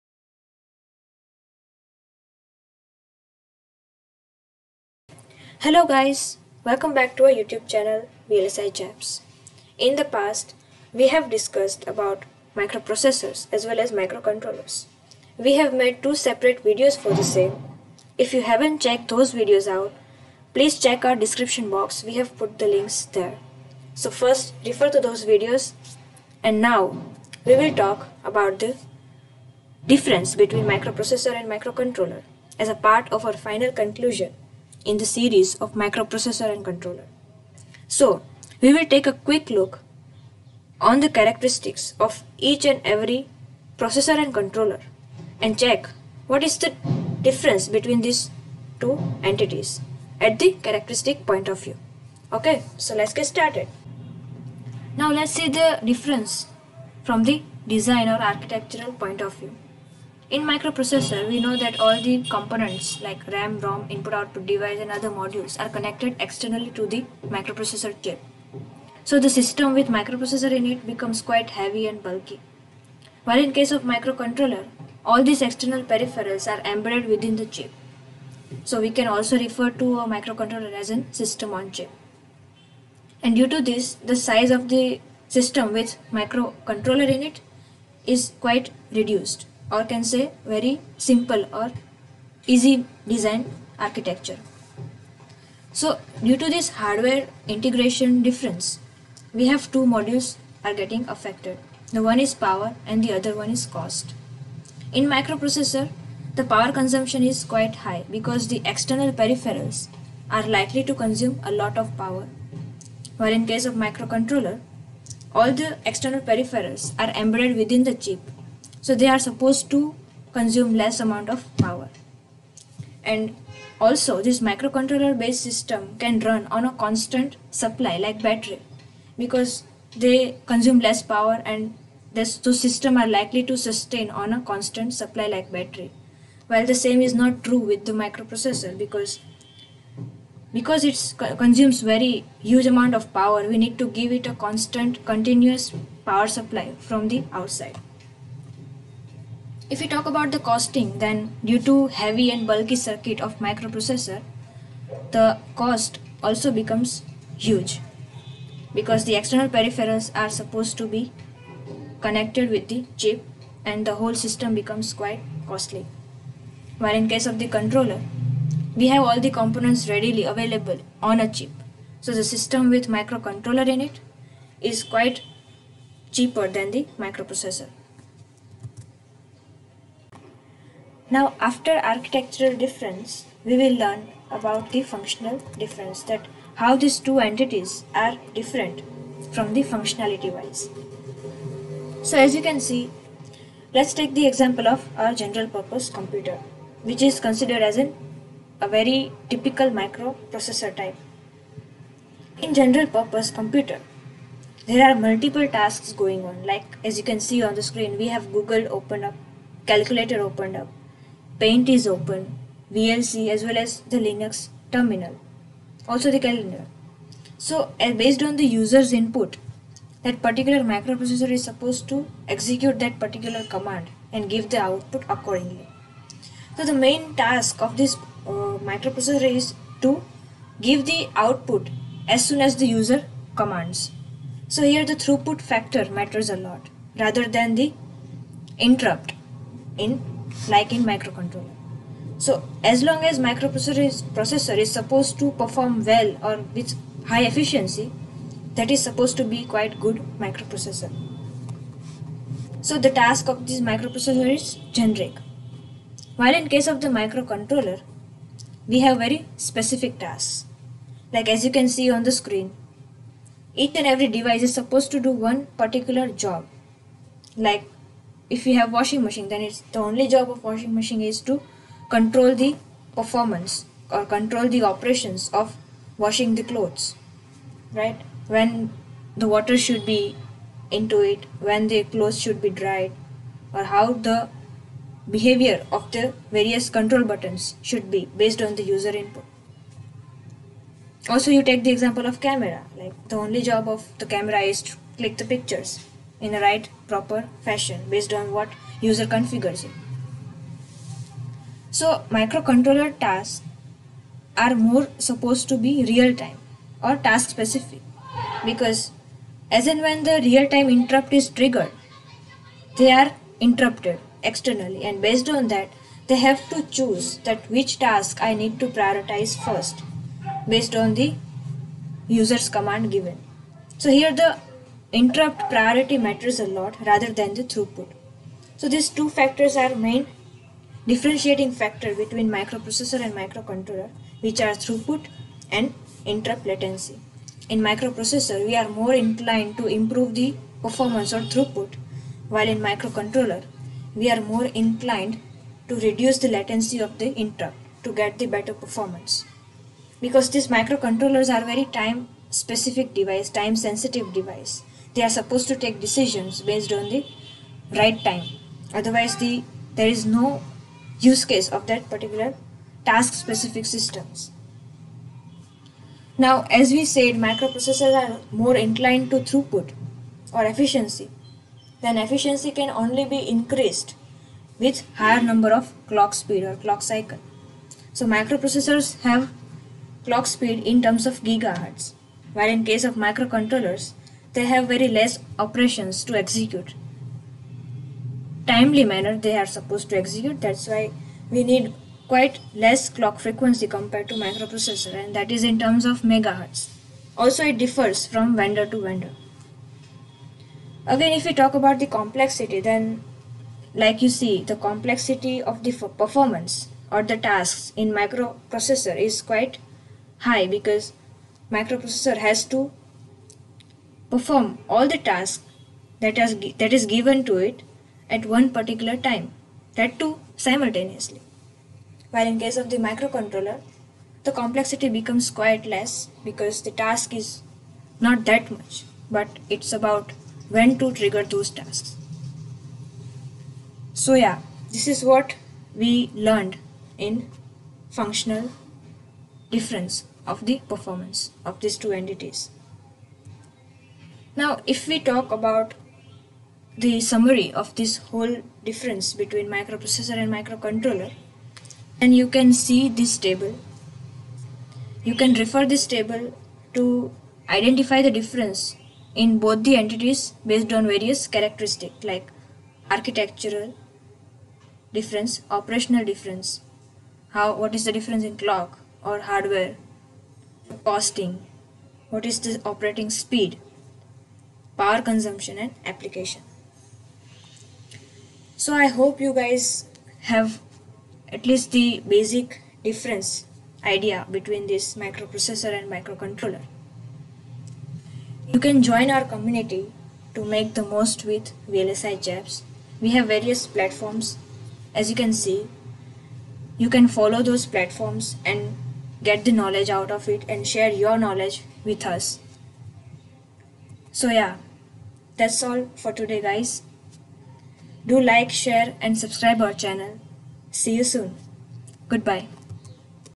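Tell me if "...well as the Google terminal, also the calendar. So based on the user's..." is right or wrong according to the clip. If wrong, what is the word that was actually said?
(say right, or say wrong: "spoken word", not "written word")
wrong: "Linux", not "Google".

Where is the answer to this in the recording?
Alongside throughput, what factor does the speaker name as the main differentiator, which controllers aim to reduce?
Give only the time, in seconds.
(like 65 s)
336 s.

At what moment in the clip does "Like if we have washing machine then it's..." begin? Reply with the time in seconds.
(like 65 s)
267 s.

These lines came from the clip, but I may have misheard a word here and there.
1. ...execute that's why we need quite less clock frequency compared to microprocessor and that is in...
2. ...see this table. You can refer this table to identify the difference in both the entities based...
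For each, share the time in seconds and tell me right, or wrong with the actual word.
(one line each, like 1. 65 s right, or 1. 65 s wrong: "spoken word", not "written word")
1. 389 s right
2. 452 s right.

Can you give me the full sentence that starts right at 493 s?
We have various platforms as you can see.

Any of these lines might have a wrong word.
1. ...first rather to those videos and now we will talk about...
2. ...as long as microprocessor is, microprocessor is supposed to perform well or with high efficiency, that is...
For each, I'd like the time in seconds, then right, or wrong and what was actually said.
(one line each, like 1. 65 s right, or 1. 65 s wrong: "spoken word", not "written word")
1. 24 s wrong: "refer", not "rather"
2. 242 s wrong: "processor", not "microprocessor".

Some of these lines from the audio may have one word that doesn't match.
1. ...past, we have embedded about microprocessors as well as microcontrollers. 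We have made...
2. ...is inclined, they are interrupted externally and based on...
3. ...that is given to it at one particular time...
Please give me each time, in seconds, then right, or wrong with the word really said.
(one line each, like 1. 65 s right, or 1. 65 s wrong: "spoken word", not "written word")
1. 10 s wrong: "discussed", not "embedded"
2. 311 s wrong: "triggered", not "inclined"
3. 416 s right.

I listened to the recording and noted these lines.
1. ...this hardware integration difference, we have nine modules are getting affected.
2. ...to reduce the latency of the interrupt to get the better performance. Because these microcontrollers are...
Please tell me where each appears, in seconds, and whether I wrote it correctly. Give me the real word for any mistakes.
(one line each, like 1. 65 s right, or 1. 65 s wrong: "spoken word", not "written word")
1. 96 s wrong: "two", not "nine"
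2. 345 s right.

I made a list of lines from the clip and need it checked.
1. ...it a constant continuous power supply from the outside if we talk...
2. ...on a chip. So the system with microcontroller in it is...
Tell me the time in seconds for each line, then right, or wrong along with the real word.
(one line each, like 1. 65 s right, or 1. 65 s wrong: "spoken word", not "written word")
1. 144 s right
2. 171 s right.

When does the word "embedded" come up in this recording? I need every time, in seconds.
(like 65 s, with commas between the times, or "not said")
76 s, 117 s.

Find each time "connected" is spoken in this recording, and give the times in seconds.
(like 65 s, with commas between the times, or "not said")
65 s, 162 s.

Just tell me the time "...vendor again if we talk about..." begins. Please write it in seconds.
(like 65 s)
398 s.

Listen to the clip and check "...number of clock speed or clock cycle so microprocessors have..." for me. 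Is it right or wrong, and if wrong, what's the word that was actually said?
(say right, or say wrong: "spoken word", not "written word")
right.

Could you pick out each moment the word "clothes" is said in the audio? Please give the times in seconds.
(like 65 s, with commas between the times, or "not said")
276 s, 281 s.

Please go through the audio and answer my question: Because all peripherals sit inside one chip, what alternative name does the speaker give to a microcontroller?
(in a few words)
system on chip.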